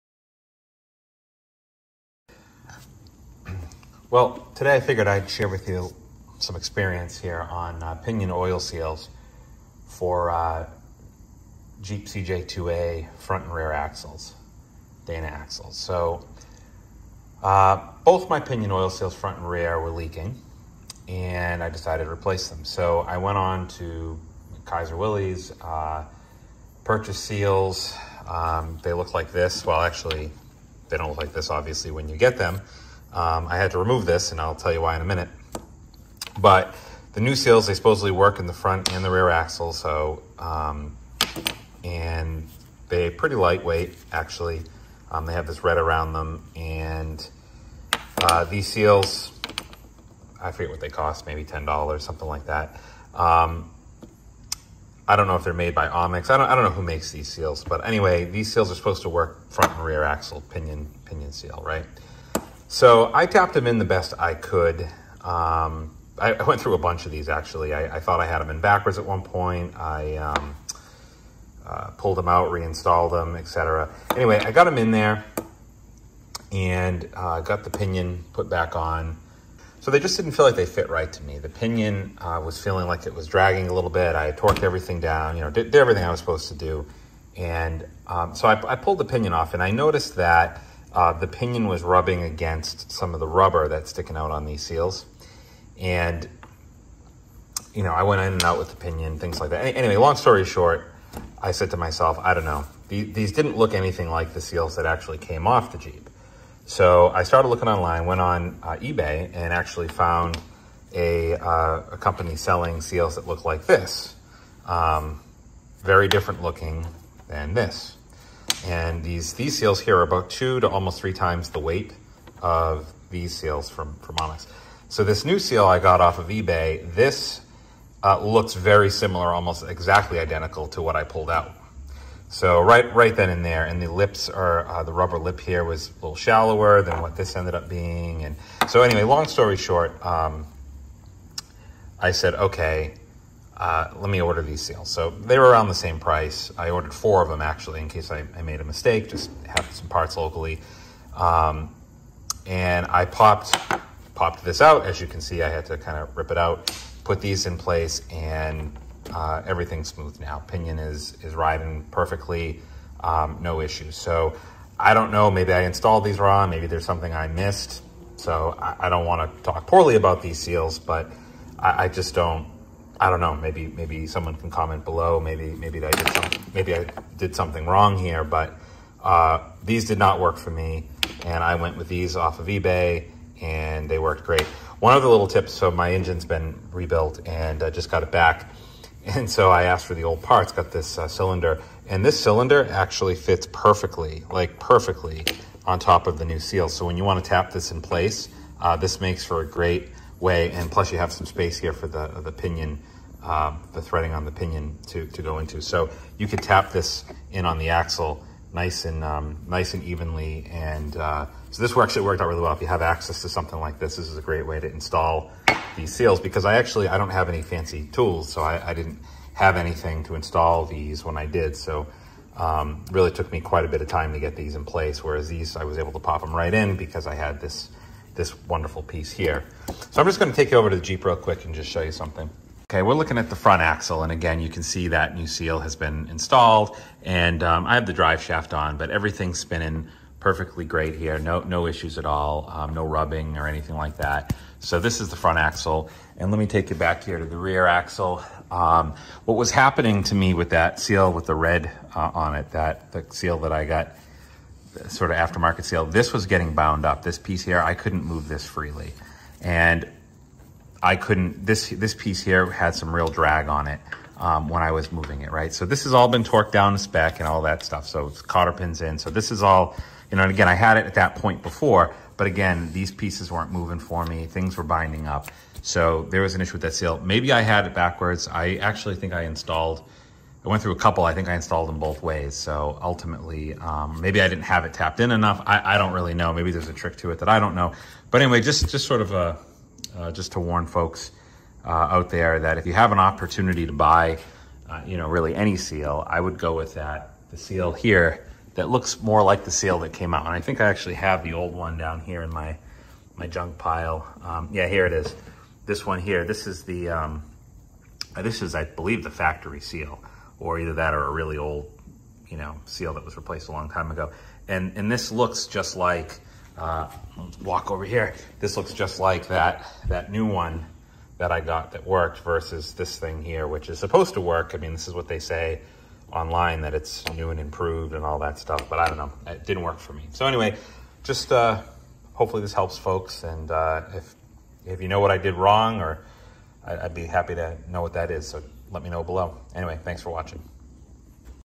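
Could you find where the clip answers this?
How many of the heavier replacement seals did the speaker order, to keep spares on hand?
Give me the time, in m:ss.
2:26.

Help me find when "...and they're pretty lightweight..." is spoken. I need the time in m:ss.
0:41.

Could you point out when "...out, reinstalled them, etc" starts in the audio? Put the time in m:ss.
1:12.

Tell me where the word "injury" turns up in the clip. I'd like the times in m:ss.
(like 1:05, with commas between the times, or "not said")
not said.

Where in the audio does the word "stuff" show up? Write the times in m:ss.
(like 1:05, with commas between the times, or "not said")
4:27, 5:28.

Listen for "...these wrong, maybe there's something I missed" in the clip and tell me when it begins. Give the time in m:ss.
2:46.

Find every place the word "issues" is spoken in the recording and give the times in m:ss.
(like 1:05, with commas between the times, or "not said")
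2:43, 4:01, 4:36.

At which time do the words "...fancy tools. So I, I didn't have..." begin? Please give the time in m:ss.
3:37.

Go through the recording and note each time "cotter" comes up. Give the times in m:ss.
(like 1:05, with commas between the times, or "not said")
4:28.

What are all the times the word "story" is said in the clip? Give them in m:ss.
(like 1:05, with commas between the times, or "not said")
1:40, 2:19.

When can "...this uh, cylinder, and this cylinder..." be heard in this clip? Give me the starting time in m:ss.
3:10.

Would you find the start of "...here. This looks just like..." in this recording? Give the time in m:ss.
5:17.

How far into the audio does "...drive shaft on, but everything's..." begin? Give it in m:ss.
3:57.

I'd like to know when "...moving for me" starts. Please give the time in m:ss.
4:33.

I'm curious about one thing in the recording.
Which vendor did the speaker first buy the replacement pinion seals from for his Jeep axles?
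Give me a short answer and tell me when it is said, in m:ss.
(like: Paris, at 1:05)
Kaiser Willys, at 0:24.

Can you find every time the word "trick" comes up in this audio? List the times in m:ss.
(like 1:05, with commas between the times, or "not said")
4:46.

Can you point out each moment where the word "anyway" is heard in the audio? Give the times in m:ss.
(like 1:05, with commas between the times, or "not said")
0:57, 1:14, 1:39, 2:18, 4:48, 5:30, 5:39.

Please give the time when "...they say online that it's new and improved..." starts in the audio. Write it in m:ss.
5:25.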